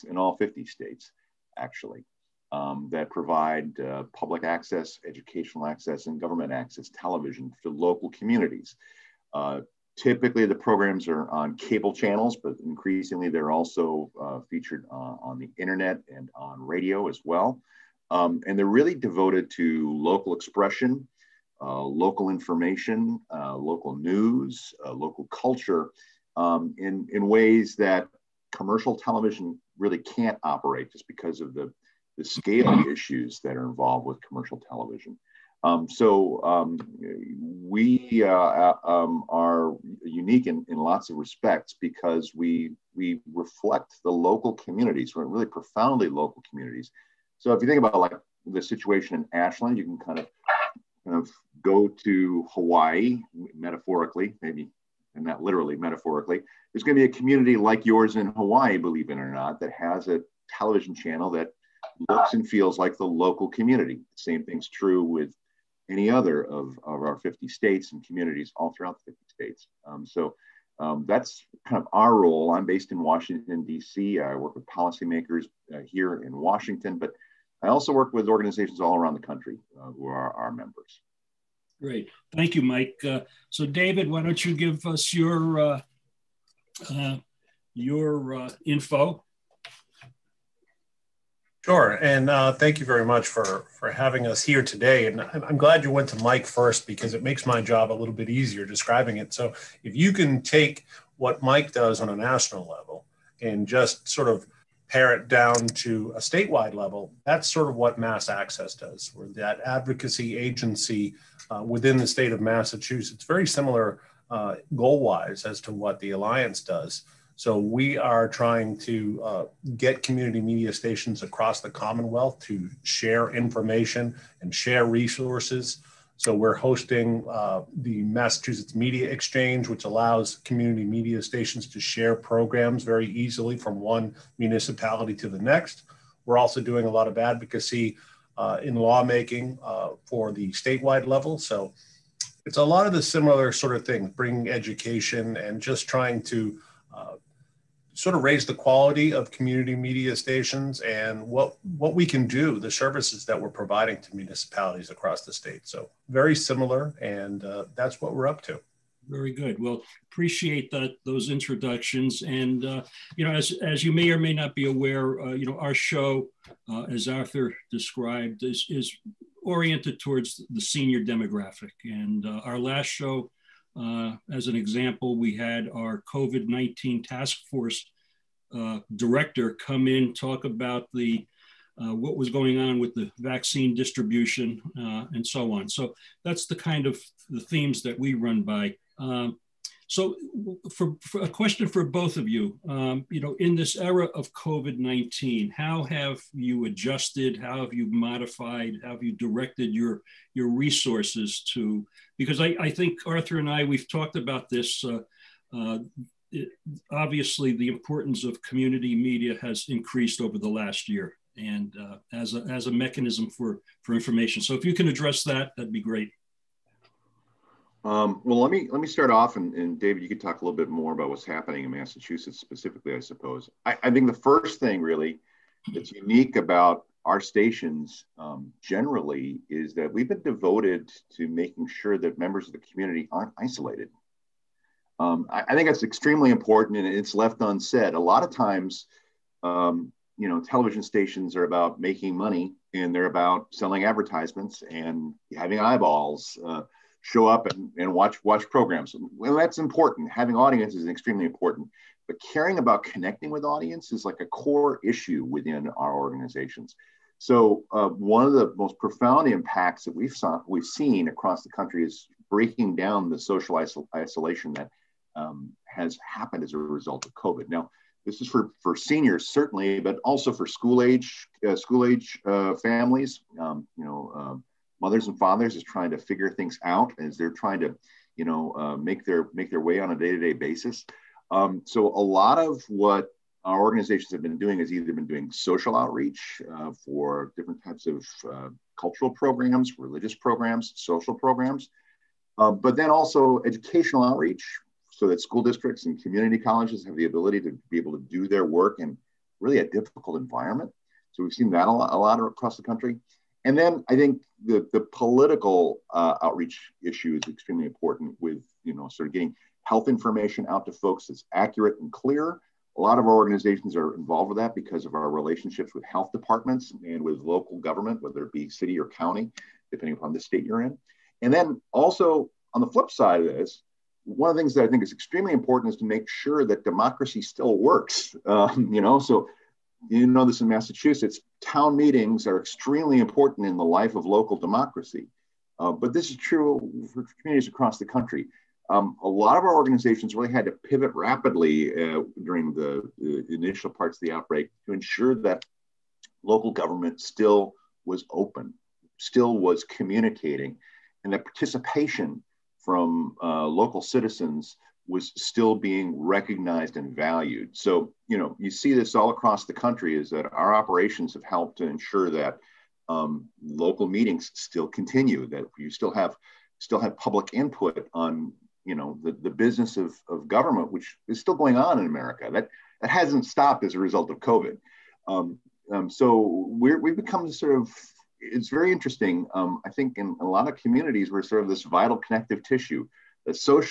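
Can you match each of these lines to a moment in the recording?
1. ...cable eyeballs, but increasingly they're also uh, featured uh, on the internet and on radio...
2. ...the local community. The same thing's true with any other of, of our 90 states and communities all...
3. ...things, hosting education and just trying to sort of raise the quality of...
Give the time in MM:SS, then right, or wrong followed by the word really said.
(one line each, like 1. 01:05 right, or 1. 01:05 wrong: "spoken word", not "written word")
1. 00:11 wrong: "channels", not "eyeballs"
2. 01:02 wrong: "50", not "90"
3. 02:23 wrong: "bringing", not "hosting".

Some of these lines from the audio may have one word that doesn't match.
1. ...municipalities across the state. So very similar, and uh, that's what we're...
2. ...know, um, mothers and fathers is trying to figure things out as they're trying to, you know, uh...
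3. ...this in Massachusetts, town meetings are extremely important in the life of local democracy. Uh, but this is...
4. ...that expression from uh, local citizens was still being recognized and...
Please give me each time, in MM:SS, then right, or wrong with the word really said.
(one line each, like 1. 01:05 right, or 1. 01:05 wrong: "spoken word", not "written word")
1. 02:34 right
2. 04:33 right
3. 05:30 right
4. 05:51 wrong: "participation", not "expression".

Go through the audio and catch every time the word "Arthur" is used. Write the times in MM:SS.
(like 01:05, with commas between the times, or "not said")
02:47, 03:23.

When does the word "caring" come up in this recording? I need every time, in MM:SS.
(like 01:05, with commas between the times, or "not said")
04:12.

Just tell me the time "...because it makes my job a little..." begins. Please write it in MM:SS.
01:36.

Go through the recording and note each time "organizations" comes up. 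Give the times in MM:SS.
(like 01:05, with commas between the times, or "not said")
01:18, 04:15, 04:43, 05:13, 05:39.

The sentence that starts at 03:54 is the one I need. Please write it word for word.
Um, I, I, think that's extremely important and it's left unsaid.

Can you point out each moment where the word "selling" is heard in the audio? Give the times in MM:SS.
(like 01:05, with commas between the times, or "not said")
04:03.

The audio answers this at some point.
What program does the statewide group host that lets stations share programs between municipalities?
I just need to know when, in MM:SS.
02:08.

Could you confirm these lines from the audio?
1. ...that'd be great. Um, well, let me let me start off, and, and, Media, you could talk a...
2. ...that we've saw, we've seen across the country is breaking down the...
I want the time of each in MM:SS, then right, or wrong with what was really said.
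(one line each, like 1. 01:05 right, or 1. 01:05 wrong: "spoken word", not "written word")
1. 03:35 wrong: "David", not "Media"
2. 04:19 right.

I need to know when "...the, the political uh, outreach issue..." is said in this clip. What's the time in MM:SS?
05:04.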